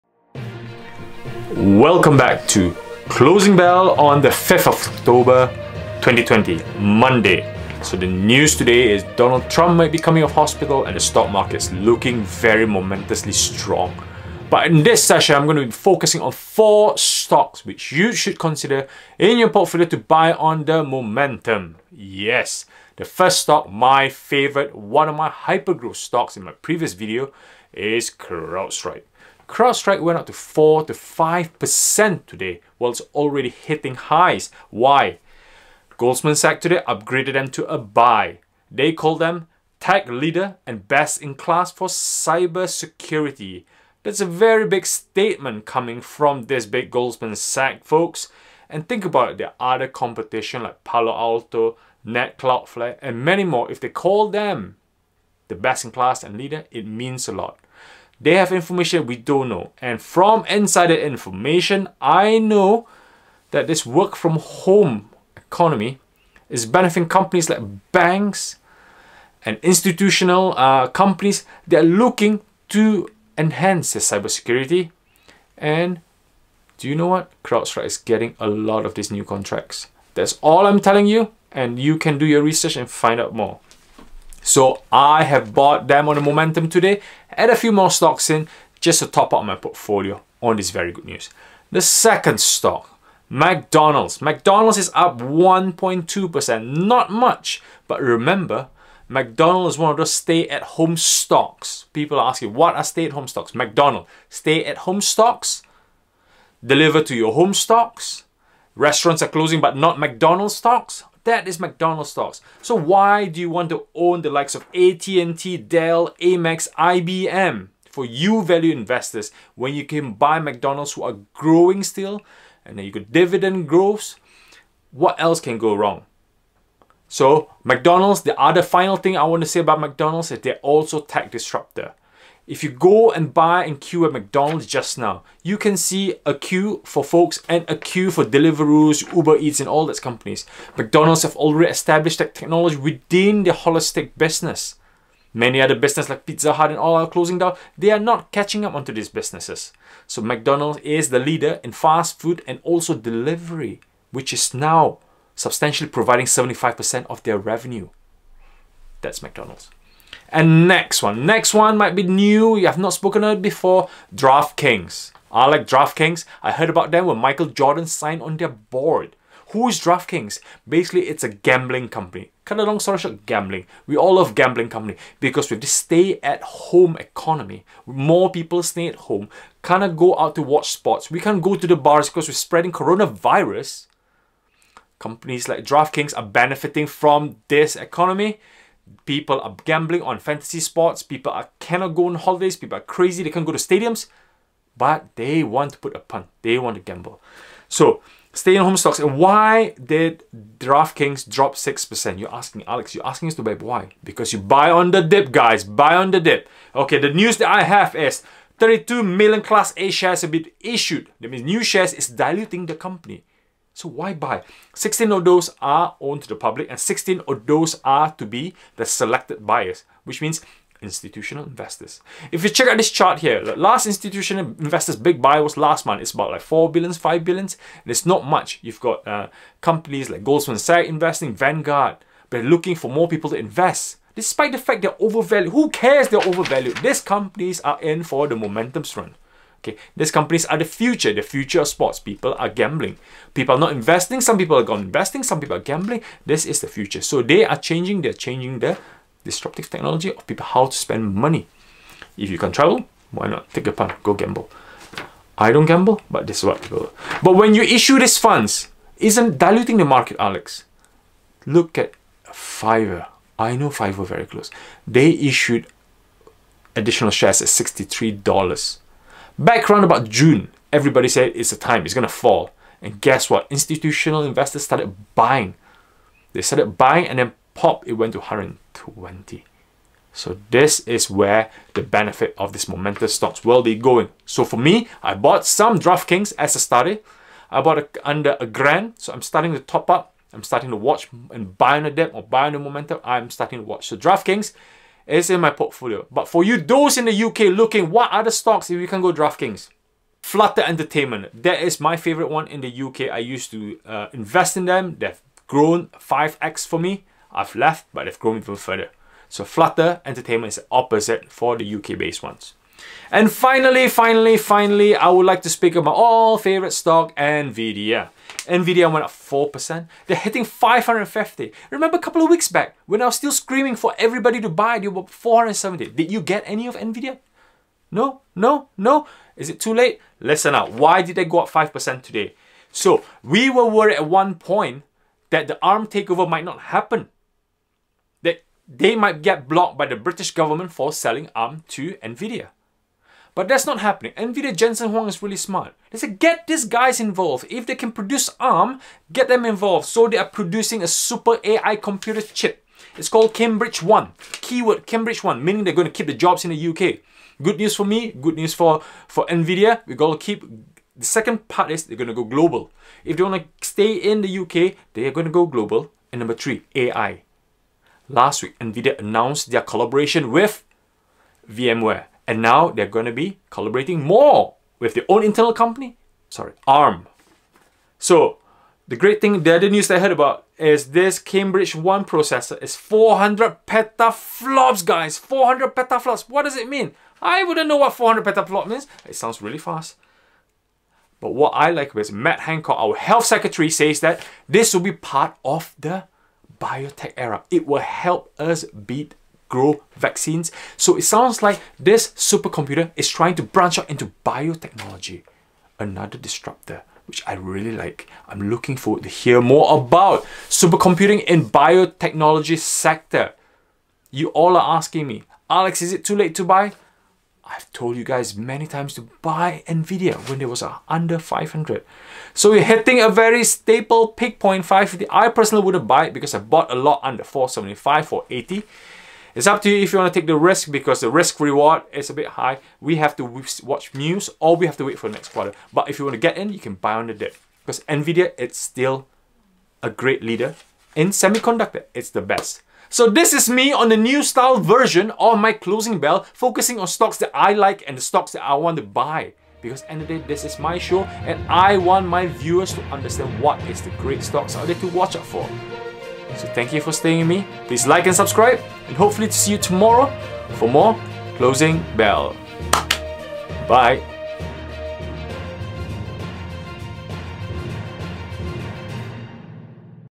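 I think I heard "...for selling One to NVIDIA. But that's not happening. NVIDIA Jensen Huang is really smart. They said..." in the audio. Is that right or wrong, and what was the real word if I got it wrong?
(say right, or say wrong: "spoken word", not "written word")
wrong: "ARM", not "One".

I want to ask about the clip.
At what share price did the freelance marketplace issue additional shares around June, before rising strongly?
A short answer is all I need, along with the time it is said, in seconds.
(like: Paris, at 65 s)
$63, at 267 s.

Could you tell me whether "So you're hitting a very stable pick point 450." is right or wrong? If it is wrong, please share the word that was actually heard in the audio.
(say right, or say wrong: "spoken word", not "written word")
wrong: "550", not "450".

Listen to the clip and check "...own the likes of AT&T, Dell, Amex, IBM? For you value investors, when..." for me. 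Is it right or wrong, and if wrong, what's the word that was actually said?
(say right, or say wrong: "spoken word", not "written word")
right.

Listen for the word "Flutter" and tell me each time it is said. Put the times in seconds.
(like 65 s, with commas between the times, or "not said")
300 s, 309 s.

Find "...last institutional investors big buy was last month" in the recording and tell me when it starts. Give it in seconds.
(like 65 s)
223 s.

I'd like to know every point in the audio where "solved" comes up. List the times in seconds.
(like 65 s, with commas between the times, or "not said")
not said.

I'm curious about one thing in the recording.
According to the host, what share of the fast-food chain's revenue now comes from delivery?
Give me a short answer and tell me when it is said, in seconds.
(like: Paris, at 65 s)
75%, at 156 s.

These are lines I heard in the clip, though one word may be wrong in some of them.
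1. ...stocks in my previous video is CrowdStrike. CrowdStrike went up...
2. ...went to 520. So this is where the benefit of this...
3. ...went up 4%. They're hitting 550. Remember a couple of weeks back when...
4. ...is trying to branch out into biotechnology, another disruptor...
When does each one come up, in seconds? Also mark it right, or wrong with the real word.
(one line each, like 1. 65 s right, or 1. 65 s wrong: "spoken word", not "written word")
1. 25 s right
2. 277 s wrong: "120", not "520"
3. 318 s right
4. 402 s right.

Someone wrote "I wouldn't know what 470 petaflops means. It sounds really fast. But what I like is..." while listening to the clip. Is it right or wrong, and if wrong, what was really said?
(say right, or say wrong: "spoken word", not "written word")
wrong: "400", not "470".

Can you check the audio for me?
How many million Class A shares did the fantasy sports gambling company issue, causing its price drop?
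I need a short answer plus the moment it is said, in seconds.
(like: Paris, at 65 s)
32 million, at 208 s.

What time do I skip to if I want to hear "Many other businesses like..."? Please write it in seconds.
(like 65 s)
145 s.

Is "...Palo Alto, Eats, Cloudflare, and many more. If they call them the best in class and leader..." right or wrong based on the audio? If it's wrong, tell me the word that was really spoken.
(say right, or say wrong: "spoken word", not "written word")
wrong: "Net", not "Eats".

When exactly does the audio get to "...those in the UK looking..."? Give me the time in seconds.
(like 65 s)
296 s.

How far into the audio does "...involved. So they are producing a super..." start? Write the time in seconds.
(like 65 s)
349 s.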